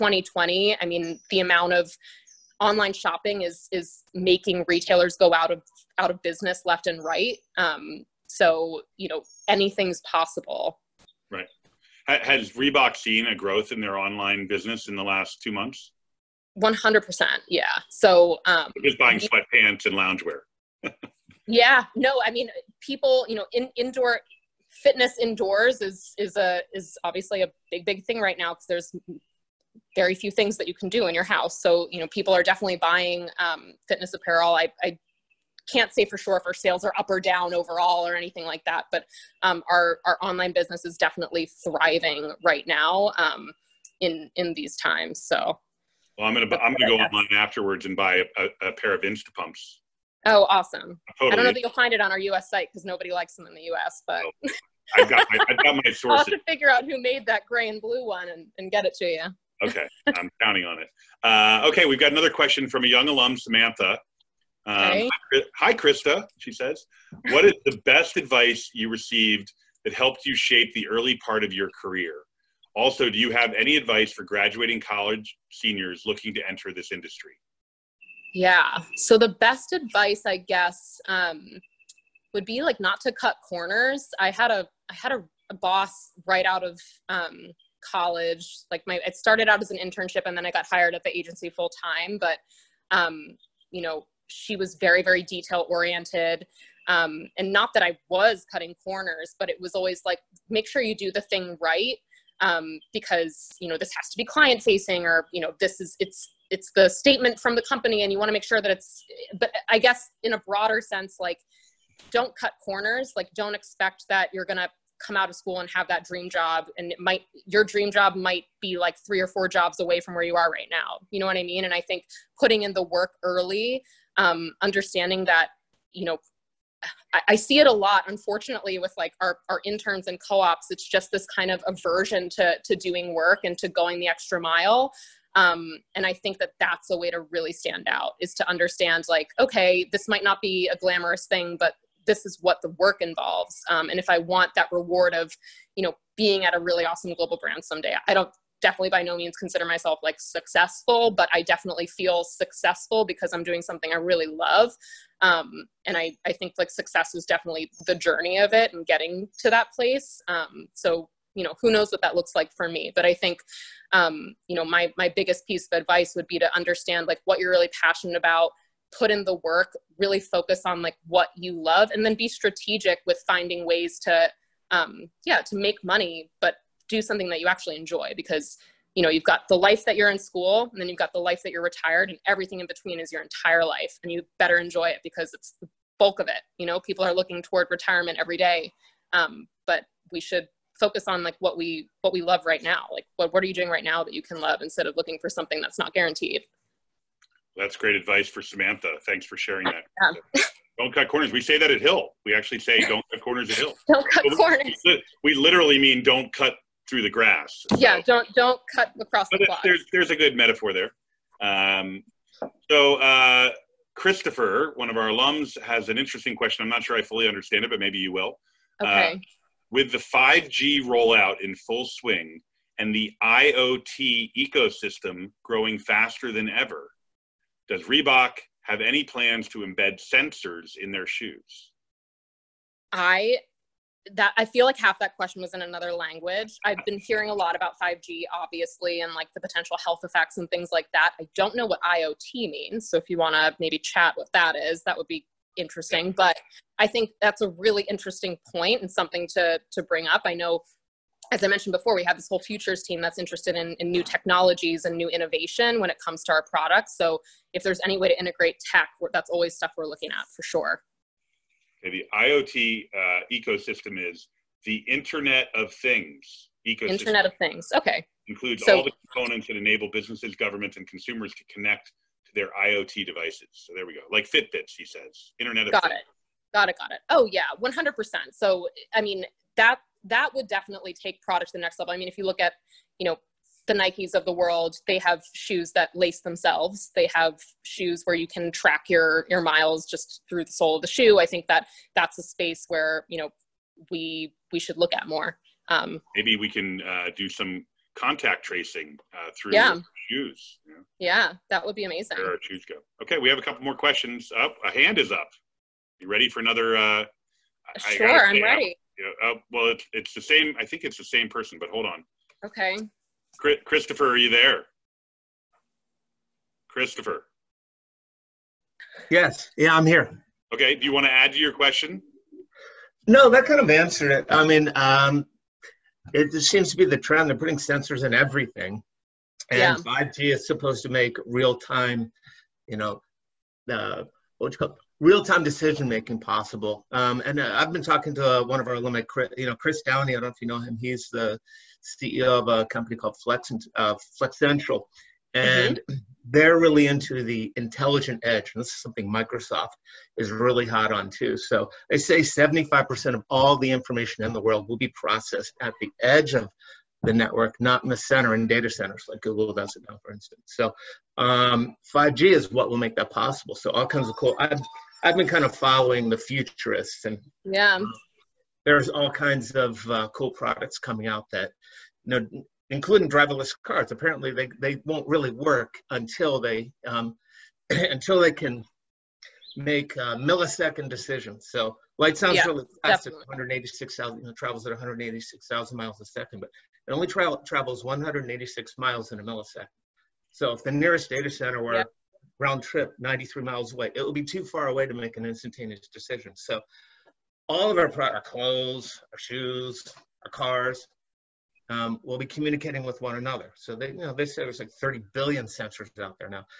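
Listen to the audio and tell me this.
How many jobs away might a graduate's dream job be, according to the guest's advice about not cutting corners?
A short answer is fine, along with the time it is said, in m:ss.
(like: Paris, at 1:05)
3 or 4, at 1:59.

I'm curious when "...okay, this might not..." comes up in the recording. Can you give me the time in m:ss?
2:19.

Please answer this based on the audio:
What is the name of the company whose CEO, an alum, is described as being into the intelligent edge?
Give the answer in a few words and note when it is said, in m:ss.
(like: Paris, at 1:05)
Flex Central, at 5:44.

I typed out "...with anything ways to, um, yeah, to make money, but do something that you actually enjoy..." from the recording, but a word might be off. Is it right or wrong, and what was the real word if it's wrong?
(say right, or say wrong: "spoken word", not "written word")
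wrong: "finding", not "anything".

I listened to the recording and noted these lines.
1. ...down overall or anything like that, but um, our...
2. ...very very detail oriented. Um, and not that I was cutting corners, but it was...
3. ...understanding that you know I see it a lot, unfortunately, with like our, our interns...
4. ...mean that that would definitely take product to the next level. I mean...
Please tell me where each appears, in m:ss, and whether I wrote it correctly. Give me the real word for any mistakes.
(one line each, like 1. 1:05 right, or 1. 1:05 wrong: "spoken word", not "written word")
1. 0:37 right
2. 1:34 right
3. 2:04 right
4. 4:39 right.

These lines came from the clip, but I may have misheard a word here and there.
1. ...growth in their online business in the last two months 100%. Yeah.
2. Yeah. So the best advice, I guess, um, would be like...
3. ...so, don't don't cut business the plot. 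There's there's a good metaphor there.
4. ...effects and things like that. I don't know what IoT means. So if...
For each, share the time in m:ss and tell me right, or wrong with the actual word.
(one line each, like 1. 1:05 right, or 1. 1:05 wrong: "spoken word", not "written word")
1. 0:13 right
2. 1:18 right
3. 3:27 wrong: "across", not "business"
4. 4:00 right.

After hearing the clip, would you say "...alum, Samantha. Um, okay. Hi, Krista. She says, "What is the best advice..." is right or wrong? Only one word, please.
right.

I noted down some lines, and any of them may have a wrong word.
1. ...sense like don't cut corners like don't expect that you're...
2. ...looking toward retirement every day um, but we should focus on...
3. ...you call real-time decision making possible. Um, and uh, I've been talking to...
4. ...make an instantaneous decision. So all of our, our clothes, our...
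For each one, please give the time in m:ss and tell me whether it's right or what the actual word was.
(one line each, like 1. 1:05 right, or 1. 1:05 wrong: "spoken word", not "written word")
1. 1:50 right
2. 3:07 right
3. 5:34 right
4. 6:34 right.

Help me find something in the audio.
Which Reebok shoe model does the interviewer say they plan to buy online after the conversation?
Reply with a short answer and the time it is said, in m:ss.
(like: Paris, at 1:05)
Instapumps, at 0:49.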